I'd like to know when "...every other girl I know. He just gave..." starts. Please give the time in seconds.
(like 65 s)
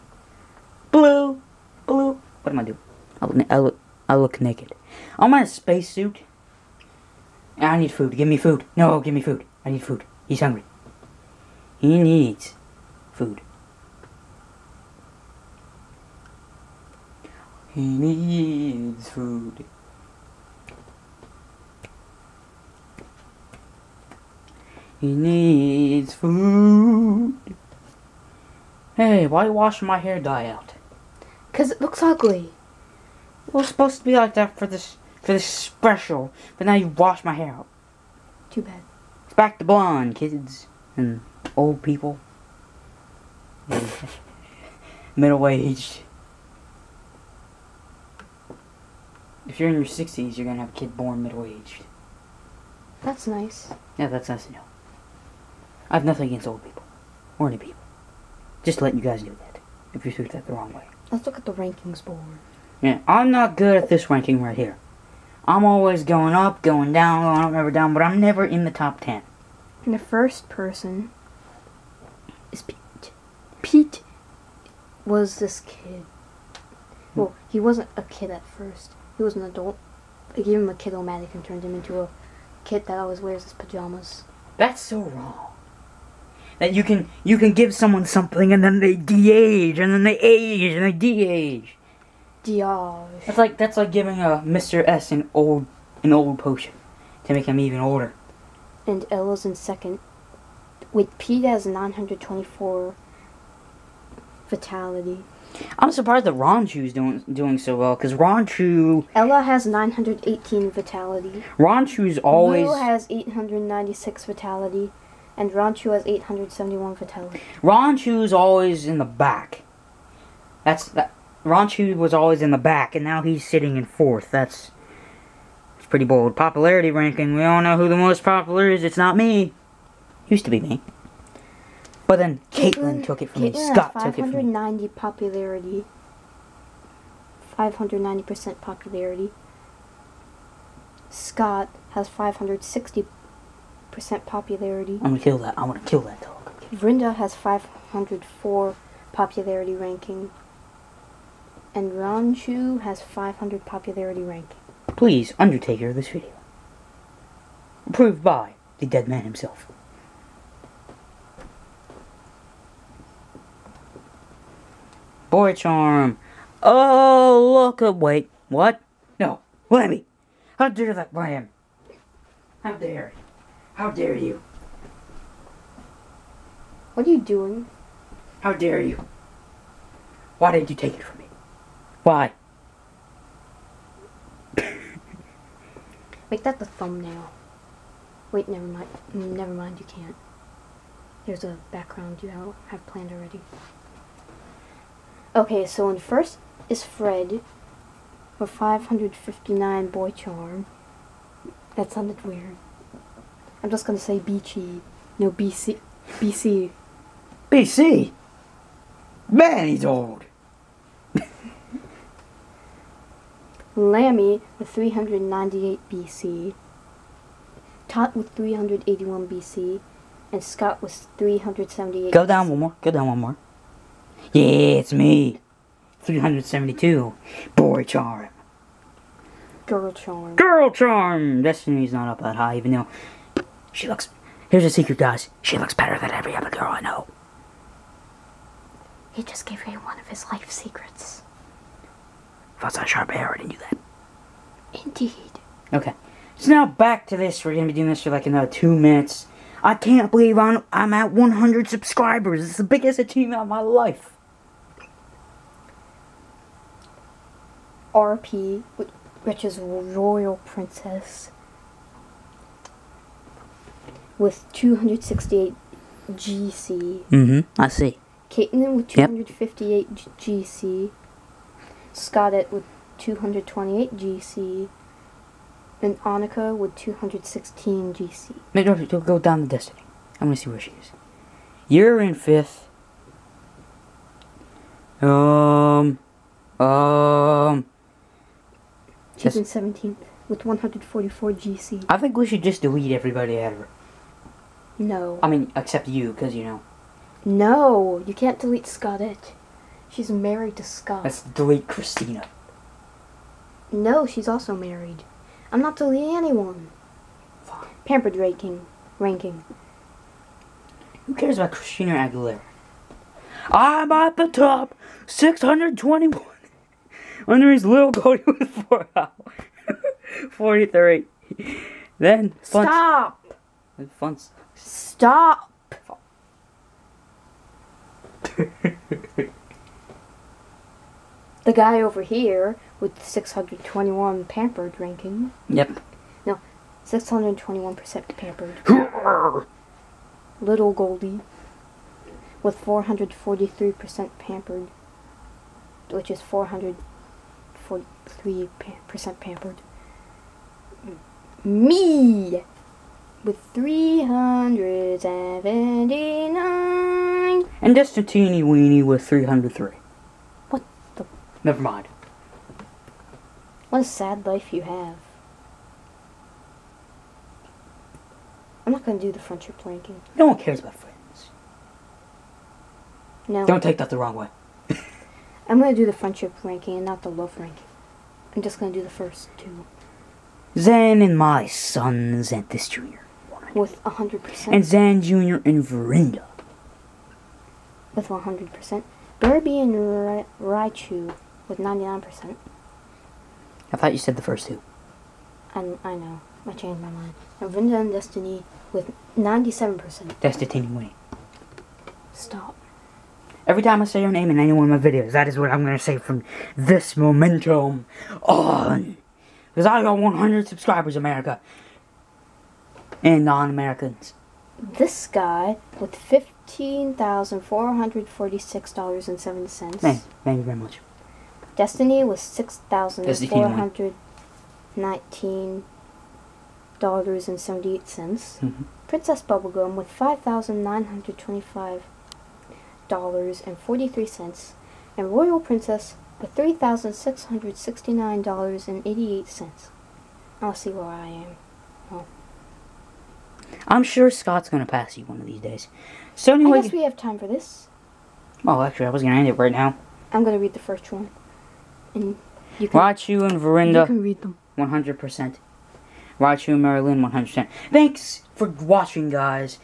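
236 s.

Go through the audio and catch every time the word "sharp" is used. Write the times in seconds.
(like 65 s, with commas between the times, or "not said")
242 s.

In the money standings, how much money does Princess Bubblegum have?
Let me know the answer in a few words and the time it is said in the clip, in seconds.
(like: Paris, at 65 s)
$5,925.43, at 430 s.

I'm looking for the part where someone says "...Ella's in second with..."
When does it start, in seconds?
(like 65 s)
99 s.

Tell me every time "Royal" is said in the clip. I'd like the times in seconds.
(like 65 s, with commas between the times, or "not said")
259 s, 435 s.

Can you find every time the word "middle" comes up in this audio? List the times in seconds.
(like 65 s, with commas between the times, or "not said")
45 s, 51 s.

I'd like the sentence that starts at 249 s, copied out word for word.
I can't believe I'm, I'm at 100 subscribers.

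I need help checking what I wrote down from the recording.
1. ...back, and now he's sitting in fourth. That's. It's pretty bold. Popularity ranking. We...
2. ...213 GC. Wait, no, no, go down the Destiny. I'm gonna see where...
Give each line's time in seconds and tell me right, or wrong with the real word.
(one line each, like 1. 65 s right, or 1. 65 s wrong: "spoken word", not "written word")
1. 122 s right
2. 276 s wrong: "216", not "213".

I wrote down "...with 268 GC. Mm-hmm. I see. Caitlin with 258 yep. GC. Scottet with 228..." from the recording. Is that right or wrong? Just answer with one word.
right.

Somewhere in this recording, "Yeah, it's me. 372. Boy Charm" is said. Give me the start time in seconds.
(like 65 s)
224 s.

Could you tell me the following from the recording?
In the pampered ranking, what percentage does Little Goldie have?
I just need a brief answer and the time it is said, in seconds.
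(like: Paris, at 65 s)
443%, at 342 s.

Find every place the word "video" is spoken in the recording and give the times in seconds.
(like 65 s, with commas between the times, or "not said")
156 s, 404 s.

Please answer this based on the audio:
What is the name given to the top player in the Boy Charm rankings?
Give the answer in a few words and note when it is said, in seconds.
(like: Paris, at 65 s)
Fred, at 196 s.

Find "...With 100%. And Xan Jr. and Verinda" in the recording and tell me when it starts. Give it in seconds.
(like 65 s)
383 s.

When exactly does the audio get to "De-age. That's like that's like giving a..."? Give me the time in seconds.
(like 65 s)
92 s.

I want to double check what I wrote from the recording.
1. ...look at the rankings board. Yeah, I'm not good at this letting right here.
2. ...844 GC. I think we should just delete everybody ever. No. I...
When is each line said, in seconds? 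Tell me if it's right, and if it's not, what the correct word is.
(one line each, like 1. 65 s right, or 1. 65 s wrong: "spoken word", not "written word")
1. 61 s wrong: "ranking", not "letting"
2. 290 s wrong: "144", not "844".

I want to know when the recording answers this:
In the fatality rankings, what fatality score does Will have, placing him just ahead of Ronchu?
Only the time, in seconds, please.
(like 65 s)
112 s.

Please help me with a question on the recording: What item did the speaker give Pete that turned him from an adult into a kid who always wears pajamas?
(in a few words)
kid-o-matic.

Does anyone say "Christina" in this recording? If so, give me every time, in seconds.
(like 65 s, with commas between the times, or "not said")
301 s, 311 s.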